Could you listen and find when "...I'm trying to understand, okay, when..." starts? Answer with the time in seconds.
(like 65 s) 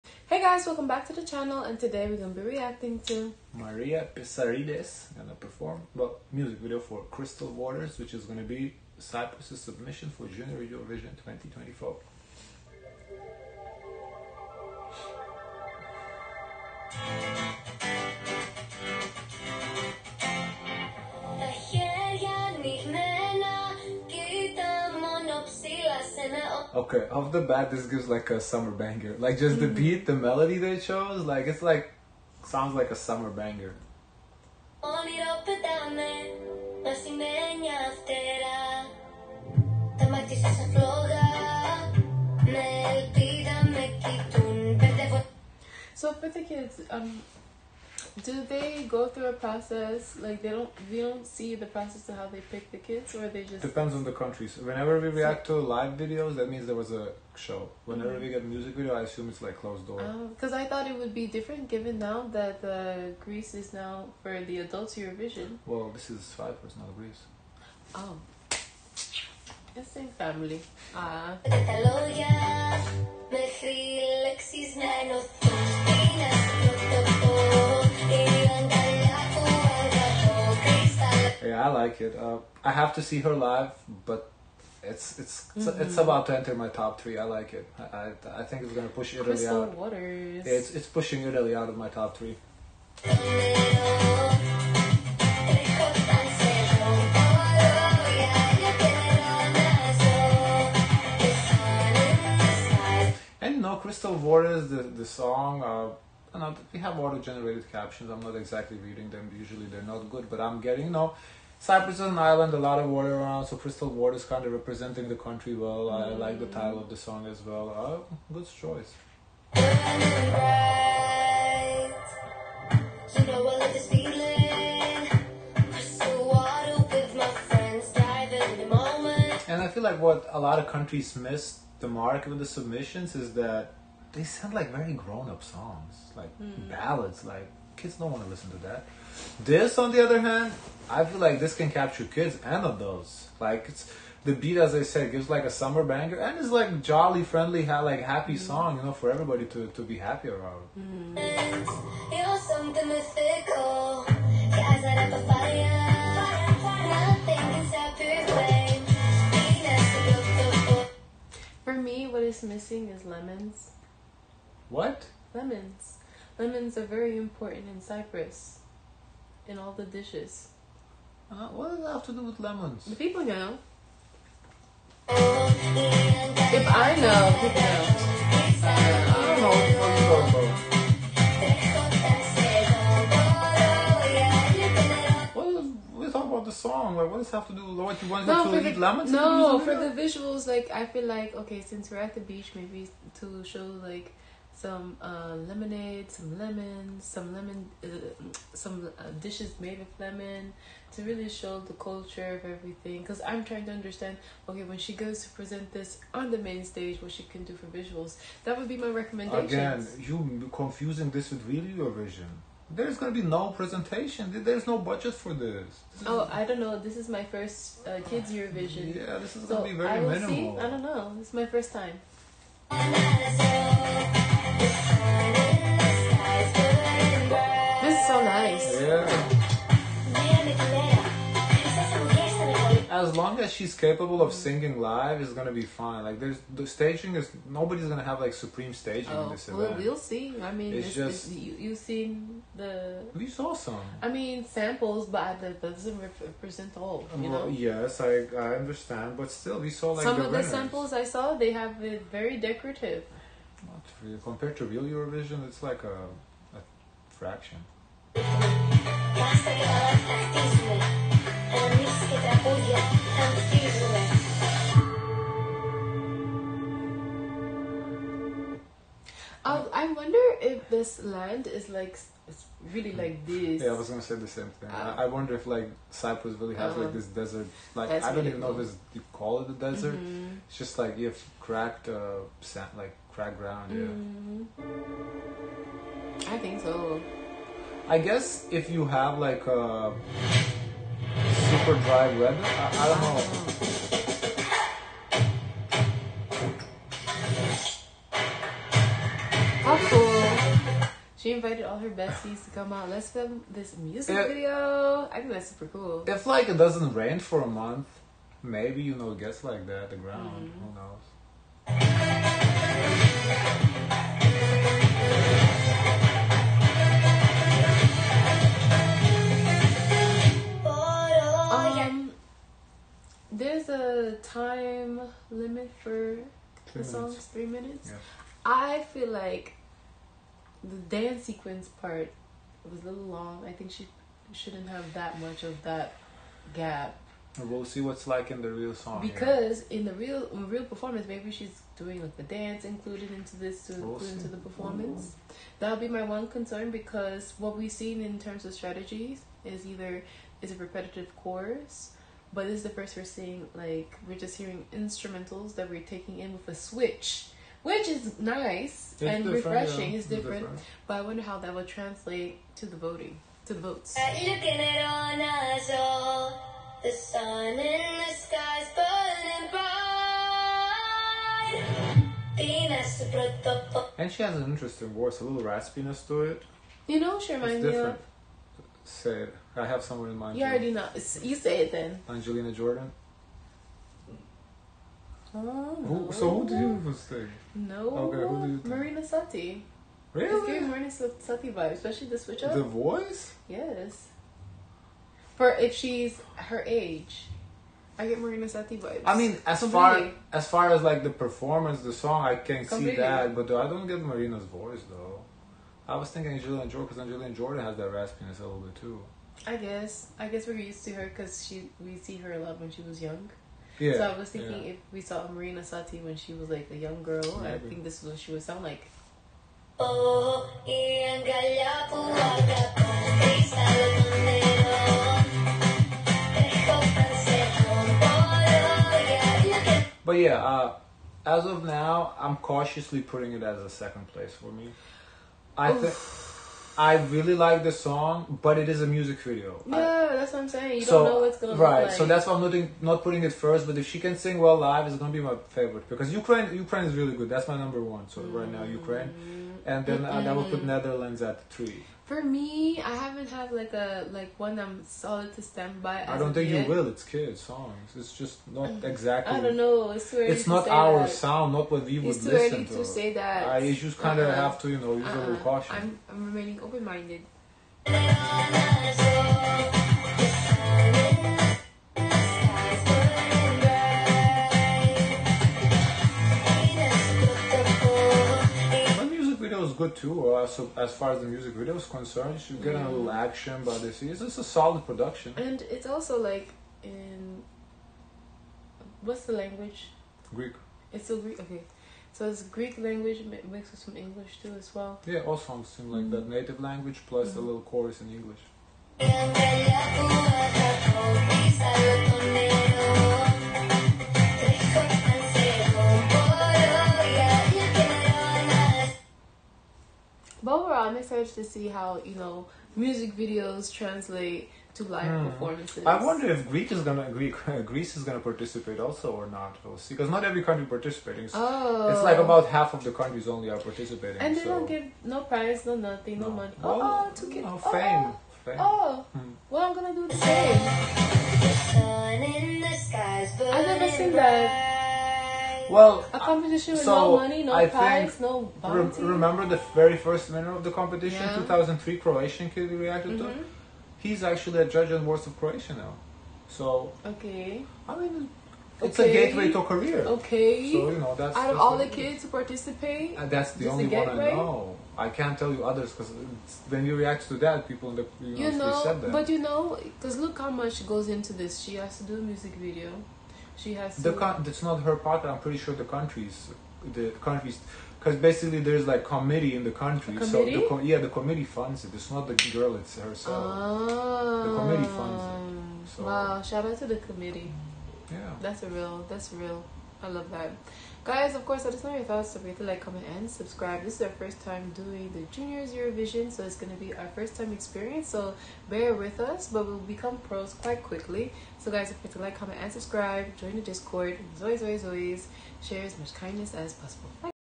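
203 s.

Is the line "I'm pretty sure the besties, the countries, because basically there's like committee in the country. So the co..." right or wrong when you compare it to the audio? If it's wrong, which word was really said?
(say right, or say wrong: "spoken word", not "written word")
wrong: "countries", not "besties".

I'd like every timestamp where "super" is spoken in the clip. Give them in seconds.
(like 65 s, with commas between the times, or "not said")
291 s, 305 s.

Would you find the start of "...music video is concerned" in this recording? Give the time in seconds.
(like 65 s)
481 s.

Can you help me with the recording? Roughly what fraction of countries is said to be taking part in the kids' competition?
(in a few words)
half.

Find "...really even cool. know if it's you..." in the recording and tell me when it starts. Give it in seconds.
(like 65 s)
278 s.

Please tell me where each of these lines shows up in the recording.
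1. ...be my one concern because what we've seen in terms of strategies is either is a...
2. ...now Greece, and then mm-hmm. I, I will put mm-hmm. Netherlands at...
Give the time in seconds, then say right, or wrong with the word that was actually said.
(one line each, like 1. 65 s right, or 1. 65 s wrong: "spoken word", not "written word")
1. 345 s right
2. 448 s wrong: "Ukraine", not "Greece".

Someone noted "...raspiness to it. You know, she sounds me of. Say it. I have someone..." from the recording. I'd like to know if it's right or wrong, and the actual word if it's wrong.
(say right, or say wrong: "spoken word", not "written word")
wrong: "reminds", not "sounds".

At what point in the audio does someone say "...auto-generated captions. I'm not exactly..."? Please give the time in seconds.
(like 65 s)
106 s.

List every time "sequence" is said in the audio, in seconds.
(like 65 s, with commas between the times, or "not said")
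331 s.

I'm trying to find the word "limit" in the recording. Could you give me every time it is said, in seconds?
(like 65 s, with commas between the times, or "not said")
325 s.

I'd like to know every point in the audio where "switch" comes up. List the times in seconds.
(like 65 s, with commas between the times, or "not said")
356 s, 392 s.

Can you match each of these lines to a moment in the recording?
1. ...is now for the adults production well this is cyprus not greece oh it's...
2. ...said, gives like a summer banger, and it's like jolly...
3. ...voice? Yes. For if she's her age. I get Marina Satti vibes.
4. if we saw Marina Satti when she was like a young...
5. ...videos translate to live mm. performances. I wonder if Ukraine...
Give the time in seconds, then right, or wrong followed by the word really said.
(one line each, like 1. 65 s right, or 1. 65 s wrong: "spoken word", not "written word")
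1. 63 s wrong: "eurovision", not "production"
2. 144 s right
3. 392 s right
4. 414 s right
5. 513 s wrong: "Greece", not "Ukraine".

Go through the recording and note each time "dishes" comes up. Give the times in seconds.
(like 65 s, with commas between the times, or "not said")
169 s, 199 s.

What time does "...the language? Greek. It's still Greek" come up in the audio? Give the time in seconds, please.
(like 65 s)
489 s.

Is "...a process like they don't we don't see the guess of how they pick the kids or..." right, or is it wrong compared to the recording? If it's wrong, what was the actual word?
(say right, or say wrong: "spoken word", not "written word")
wrong: "process", not "guess".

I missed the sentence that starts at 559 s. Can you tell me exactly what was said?
but you know, because look how much goes into this.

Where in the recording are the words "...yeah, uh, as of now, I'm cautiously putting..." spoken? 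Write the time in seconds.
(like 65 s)
430 s.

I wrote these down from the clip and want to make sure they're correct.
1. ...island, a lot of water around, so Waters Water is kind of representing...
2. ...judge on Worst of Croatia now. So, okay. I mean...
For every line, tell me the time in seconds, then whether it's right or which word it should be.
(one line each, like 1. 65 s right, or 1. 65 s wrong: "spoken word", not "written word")
1. 112 s wrong: "Crystal", not "Waters"
2. 544 s right.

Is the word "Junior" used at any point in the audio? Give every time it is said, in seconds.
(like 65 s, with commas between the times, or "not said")
10 s, 585 s.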